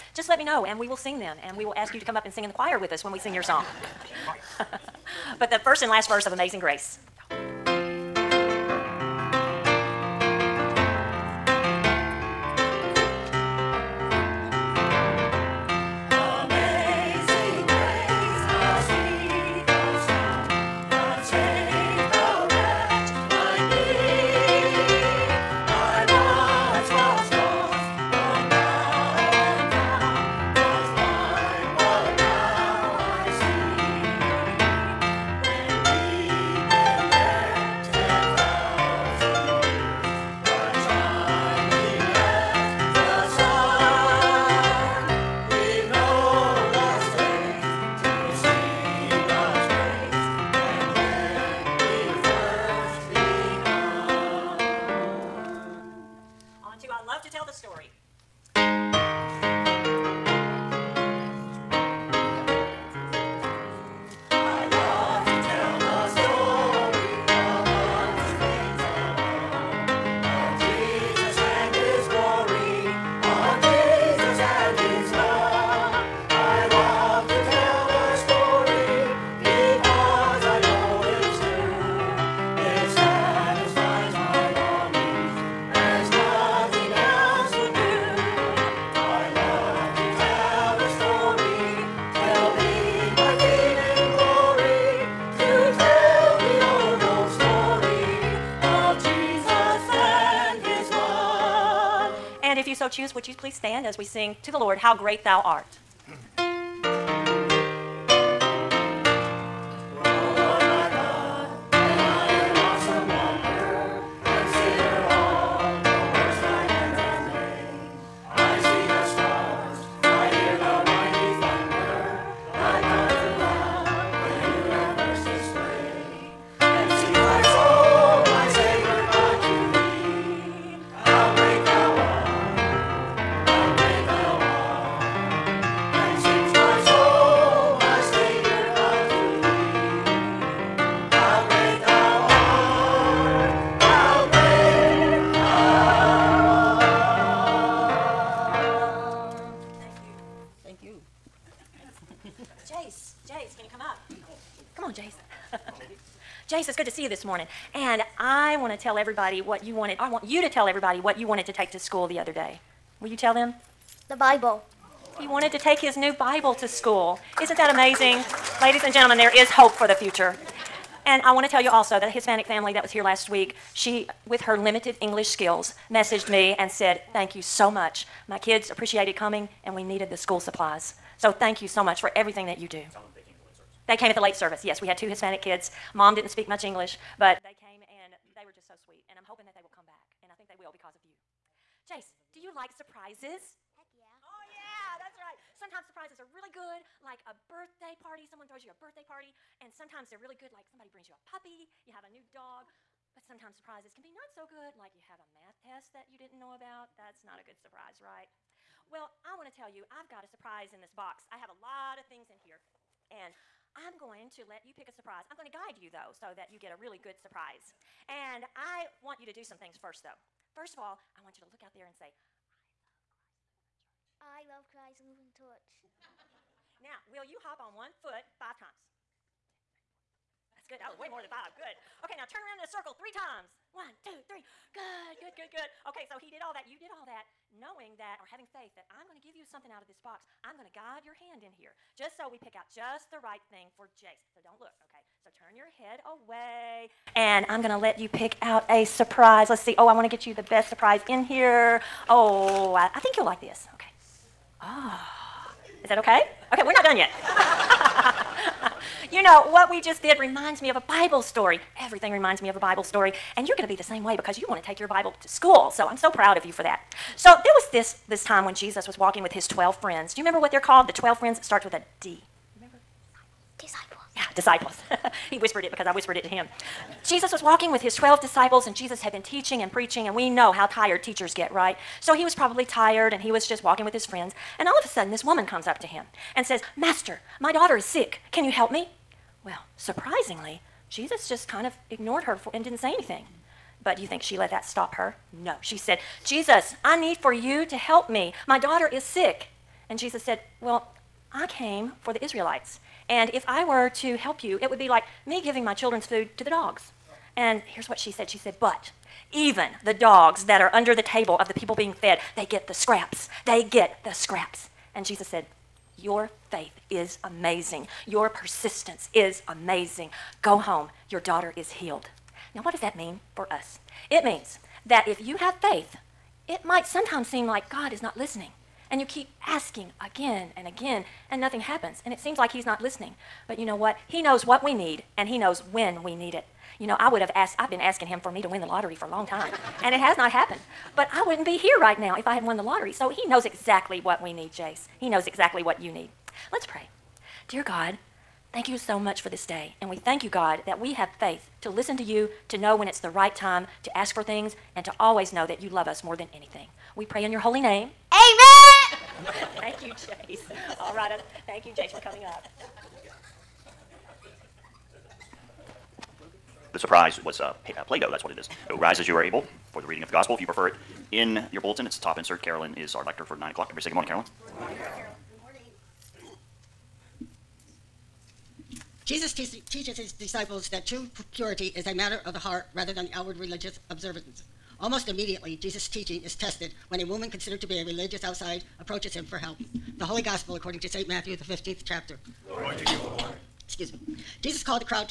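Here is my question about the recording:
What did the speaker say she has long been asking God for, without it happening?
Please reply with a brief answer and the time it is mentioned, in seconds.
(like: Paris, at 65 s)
To win the lottery, at 338 s.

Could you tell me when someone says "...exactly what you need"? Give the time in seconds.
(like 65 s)
345 s.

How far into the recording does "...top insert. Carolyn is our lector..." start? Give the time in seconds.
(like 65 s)
372 s.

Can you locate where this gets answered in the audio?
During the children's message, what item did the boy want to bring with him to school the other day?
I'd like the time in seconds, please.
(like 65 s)
165 s.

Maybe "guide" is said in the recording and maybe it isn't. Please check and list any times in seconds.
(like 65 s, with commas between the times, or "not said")
215 s, 240 s.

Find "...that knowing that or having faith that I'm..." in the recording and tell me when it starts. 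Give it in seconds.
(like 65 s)
237 s.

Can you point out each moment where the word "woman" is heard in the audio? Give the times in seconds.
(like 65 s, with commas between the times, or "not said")
285 s, 387 s.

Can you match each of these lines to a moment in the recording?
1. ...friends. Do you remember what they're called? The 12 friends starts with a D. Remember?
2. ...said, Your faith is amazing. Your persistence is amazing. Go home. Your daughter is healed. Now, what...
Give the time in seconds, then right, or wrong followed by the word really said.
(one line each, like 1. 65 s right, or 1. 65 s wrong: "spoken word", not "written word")
1. 269 s right
2. 315 s right.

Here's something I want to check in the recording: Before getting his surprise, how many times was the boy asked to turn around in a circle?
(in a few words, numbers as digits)
3.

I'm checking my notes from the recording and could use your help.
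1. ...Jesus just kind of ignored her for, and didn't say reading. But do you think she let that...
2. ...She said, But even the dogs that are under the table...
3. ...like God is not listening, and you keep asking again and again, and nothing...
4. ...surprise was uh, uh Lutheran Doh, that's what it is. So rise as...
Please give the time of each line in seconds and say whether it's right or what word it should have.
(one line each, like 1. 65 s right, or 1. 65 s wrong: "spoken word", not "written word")
1. 290 s wrong: "anything", not "reading"
2. 308 s right
3. 327 s right
4. 366 s wrong: "Play", not "Lutheran".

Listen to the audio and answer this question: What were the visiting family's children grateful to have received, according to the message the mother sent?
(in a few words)
School supplies.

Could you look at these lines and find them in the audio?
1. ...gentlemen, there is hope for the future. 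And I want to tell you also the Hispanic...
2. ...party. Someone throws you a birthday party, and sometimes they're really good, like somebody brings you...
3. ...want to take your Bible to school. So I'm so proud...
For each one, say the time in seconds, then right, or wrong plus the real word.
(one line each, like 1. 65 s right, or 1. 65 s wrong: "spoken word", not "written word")
1. 168 s right
2. 197 s right
3. 264 s right.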